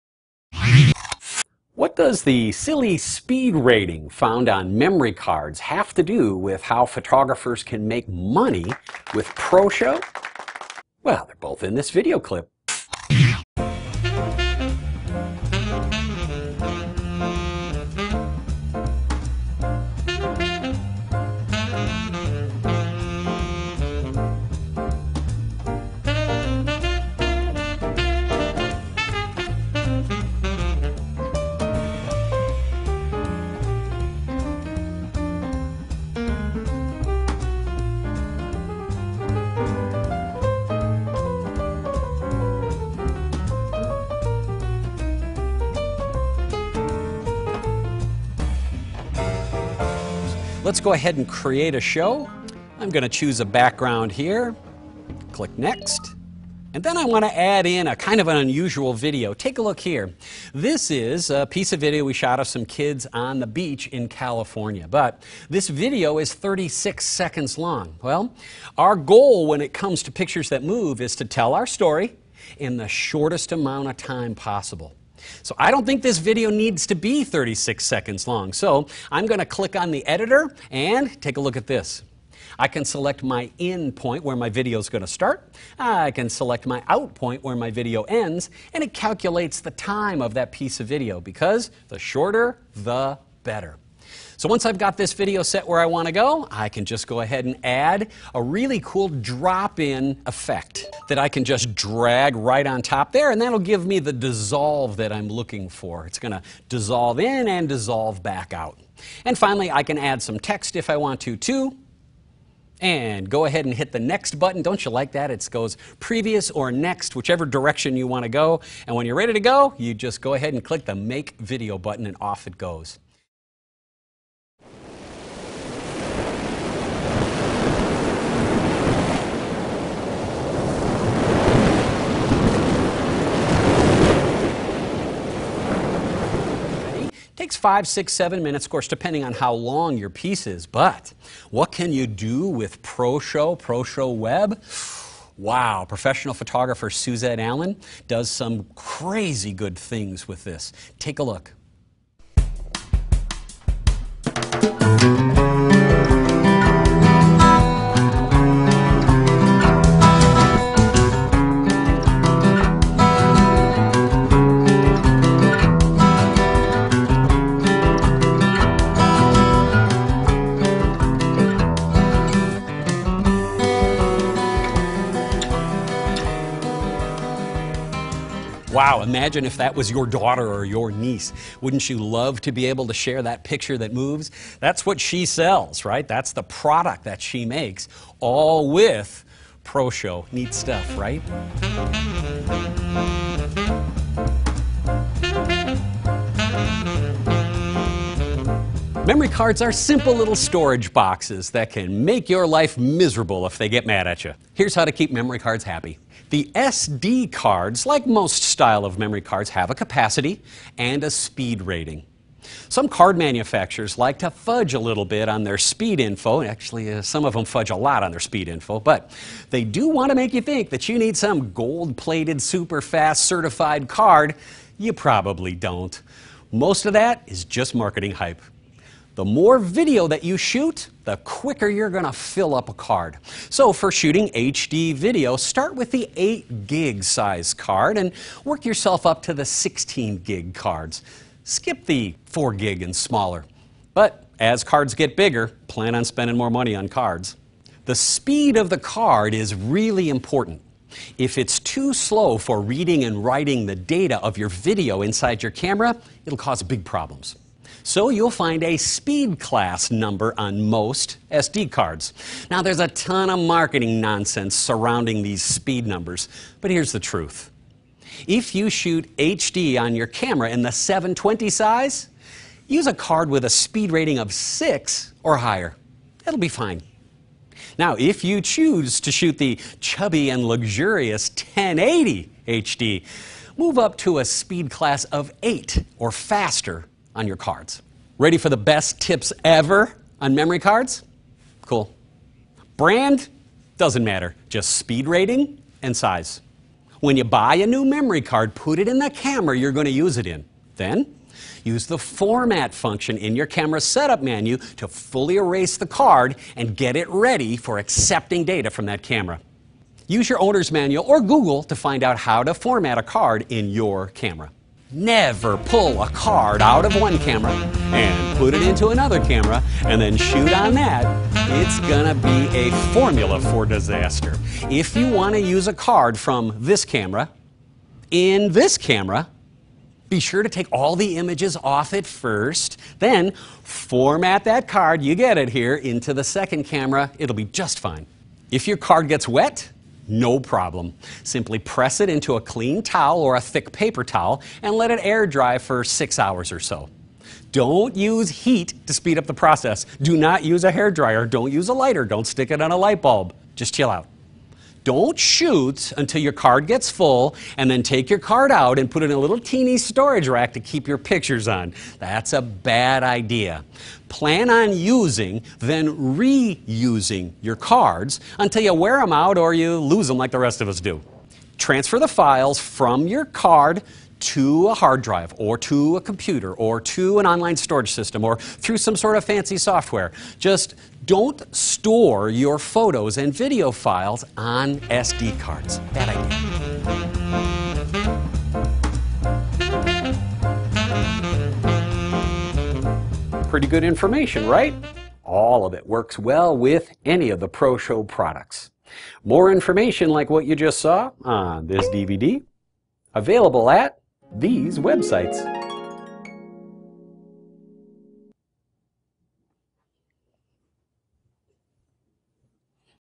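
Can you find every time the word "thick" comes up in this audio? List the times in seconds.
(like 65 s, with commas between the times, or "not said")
343 s.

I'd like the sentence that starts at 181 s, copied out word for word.
Wouldn't you love to be able to share that picture that moves?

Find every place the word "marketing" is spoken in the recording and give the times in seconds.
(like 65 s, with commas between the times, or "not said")
227 s, 263 s.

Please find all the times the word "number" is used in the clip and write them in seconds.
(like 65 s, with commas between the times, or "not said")
259 s, 265 s.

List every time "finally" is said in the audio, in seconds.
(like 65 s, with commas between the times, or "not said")
109 s.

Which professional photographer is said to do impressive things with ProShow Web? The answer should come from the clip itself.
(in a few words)
Suzette Allen.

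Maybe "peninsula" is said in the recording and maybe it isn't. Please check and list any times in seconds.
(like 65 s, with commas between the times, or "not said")
not said.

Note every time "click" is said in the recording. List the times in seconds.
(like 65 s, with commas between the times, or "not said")
55 s, 79 s, 120 s.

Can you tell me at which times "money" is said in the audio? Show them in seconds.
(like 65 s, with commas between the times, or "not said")
8 s, 246 s.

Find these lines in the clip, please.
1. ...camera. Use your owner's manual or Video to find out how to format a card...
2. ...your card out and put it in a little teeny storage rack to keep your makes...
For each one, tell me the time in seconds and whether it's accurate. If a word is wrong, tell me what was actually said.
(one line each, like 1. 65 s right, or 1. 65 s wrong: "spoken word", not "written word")
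1. 309 s wrong: "Google", not "Video"
2. 358 s wrong: "pictures", not "makes".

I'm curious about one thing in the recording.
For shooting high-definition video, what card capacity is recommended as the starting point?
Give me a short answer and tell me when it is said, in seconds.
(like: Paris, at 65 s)
8 gig, at 236 s.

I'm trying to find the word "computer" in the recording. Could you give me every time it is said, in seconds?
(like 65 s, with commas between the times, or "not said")
376 s.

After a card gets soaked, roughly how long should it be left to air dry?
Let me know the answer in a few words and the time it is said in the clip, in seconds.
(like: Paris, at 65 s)
6 hours, at 345 s.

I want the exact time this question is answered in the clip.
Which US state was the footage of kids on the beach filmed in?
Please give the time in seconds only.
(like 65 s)
64 s.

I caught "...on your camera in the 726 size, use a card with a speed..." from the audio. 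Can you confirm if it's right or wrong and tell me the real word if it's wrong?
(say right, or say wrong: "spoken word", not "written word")
wrong: "720", not "726".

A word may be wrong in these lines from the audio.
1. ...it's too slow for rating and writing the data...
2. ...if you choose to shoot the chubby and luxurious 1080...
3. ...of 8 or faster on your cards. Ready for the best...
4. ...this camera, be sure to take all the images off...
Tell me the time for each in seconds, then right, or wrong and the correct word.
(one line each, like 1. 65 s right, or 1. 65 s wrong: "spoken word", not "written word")
1. 251 s wrong: "reading", not "rating"
2. 277 s right
3. 285 s right
4. 328 s right.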